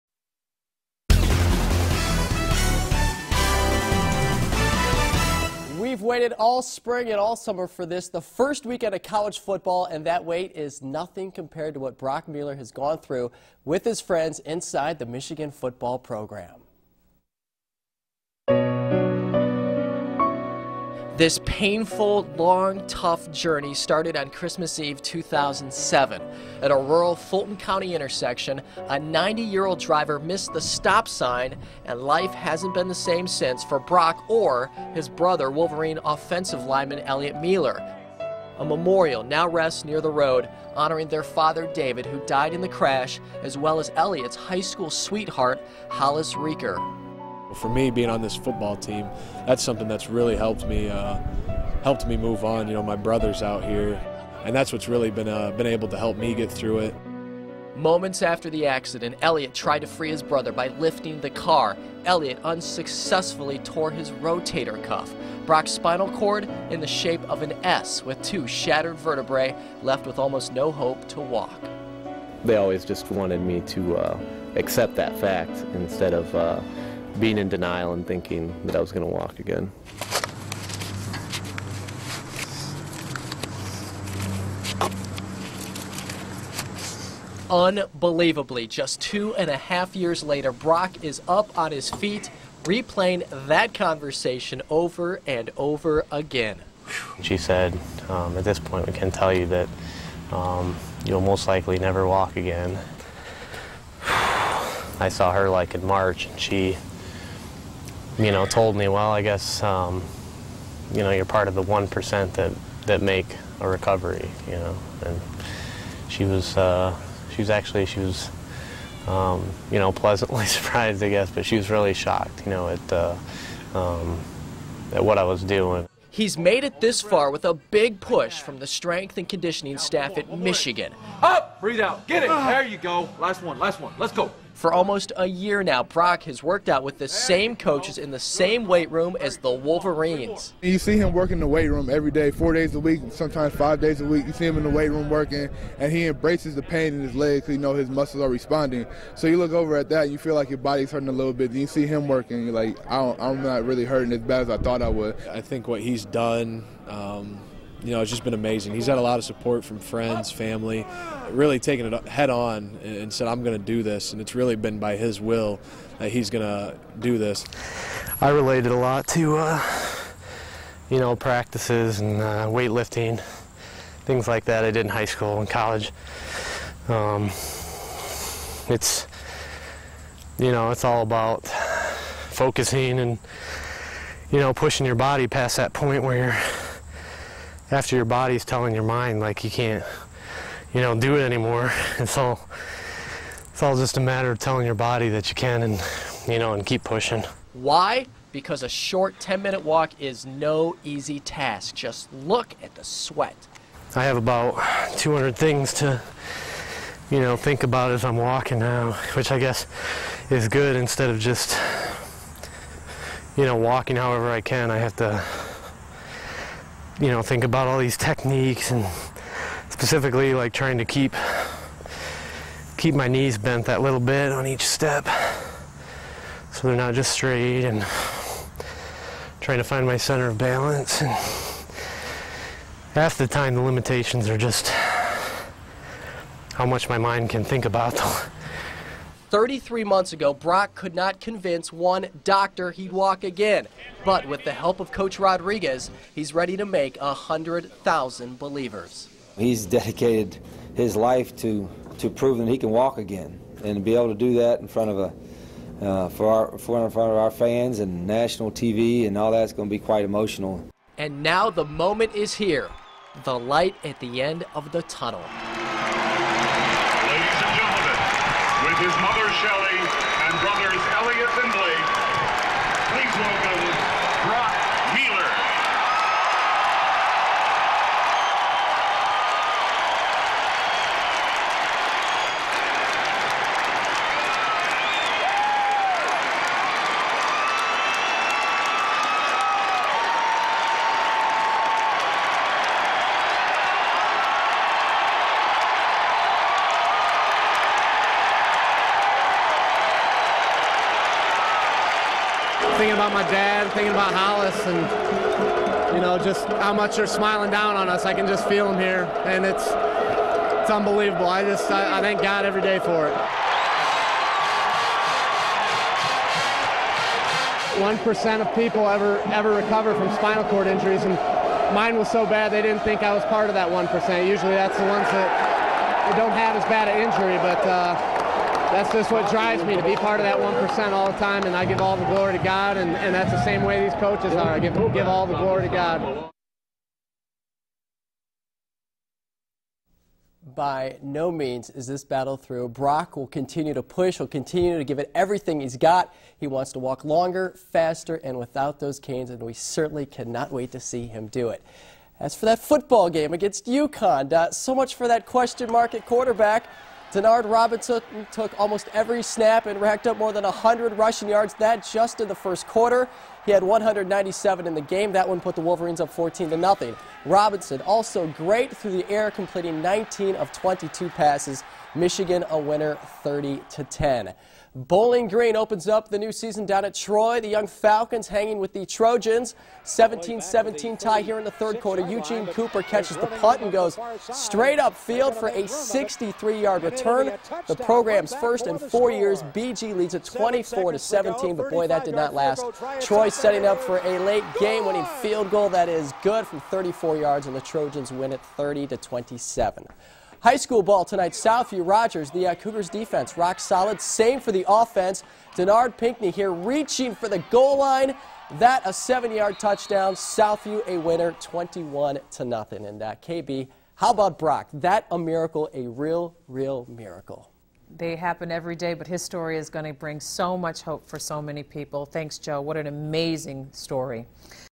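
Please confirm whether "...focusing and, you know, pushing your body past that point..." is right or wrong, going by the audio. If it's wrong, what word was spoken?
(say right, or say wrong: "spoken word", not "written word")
right.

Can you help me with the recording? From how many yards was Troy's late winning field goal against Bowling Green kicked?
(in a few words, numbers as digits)
34 yards.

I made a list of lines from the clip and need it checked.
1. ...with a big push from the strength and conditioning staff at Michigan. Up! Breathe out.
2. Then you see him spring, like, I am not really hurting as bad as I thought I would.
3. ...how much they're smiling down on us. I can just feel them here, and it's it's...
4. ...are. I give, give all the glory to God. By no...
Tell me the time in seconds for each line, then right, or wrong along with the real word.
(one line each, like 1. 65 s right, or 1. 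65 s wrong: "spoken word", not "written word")
1. 127 s right
2. 151 s wrong: "working", not "spring"
3. 306 s right
4. 334 s right.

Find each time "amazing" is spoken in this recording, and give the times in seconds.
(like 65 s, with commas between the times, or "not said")
158 s, 422 s.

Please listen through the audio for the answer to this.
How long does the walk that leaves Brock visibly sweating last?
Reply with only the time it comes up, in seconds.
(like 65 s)
199 s.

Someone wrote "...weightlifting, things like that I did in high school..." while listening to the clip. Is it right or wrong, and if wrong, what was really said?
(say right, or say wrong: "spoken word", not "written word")
right.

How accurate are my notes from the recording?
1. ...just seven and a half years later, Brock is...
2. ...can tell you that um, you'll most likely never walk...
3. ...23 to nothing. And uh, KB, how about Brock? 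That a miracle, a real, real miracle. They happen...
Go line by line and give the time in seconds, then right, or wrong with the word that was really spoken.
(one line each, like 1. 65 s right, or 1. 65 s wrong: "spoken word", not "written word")
1. 88 s wrong: "two", not "seven"
2. 98 s right
3. 411 s wrong: "21", not "23".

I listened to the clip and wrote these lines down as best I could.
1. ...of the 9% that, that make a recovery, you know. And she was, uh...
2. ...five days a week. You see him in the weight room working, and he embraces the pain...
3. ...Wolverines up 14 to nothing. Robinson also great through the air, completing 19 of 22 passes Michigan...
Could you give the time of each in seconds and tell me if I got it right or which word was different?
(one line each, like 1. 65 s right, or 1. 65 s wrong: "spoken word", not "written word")
1. 111 s wrong: "1", not "9"
2. 143 s right
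3. 365 s right.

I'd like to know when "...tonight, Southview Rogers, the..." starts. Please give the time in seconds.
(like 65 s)
401 s.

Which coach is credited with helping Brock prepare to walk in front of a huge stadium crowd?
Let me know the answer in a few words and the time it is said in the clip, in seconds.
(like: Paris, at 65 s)
Coach Rodriguez, at 244 s.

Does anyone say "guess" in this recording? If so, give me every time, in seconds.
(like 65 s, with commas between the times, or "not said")
109 s, 121 s, 209 s.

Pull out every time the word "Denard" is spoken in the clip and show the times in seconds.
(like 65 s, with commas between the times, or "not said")
357 s, 405 s.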